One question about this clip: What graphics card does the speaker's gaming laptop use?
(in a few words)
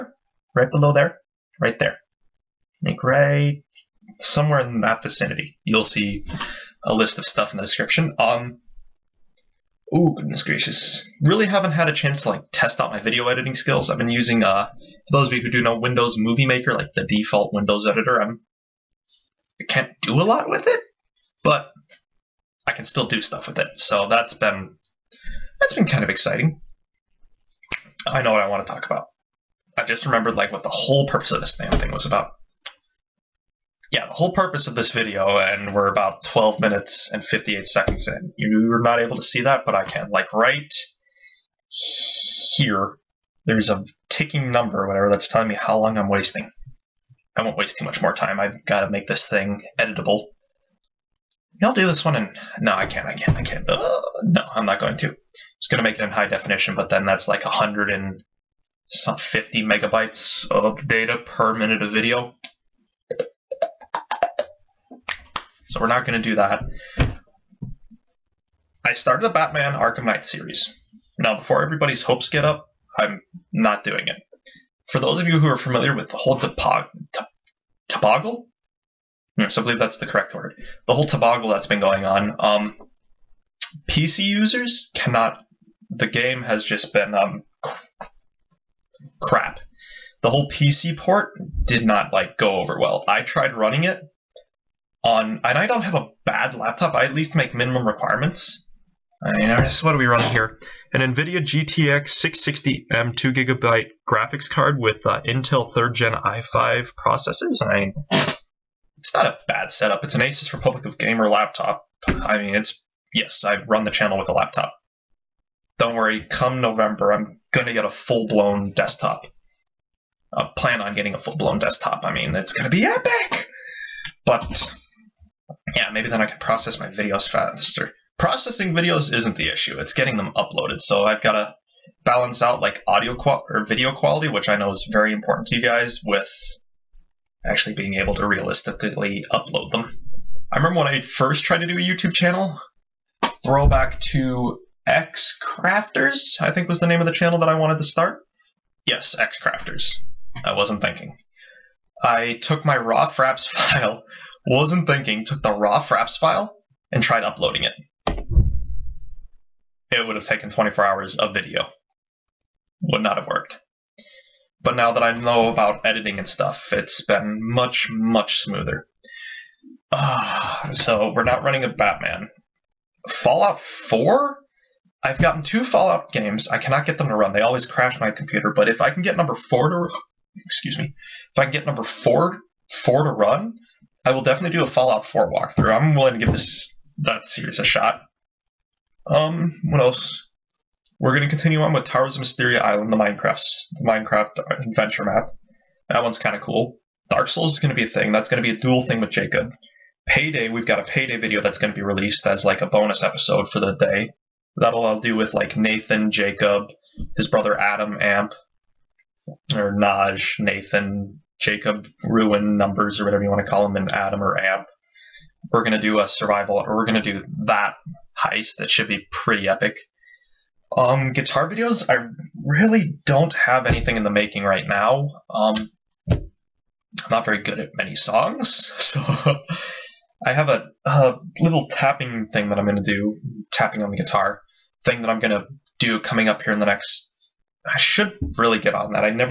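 NVIDIA GTX 660M.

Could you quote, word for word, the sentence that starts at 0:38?
You're not able to see that, but I can.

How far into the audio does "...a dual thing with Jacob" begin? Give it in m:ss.
3:18.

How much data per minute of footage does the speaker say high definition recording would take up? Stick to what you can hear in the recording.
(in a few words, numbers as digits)
150 megabytes.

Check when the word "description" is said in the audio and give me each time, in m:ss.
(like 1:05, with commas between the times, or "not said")
0:07.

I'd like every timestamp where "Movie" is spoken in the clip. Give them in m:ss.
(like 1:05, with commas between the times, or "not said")
0:16.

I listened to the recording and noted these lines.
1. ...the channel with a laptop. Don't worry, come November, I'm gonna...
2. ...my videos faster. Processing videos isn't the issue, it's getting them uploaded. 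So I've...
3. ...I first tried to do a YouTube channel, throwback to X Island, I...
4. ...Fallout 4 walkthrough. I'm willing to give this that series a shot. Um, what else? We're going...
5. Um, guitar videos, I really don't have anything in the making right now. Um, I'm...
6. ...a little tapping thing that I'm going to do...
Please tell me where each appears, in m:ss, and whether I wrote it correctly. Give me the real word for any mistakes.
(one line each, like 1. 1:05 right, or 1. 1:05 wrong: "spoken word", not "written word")
1. 1:53 right
2. 2:06 right
3. 2:20 wrong: "Crafters", not "Island"
4. 3:04 right
5. 3:40 right
6. 3:50 right.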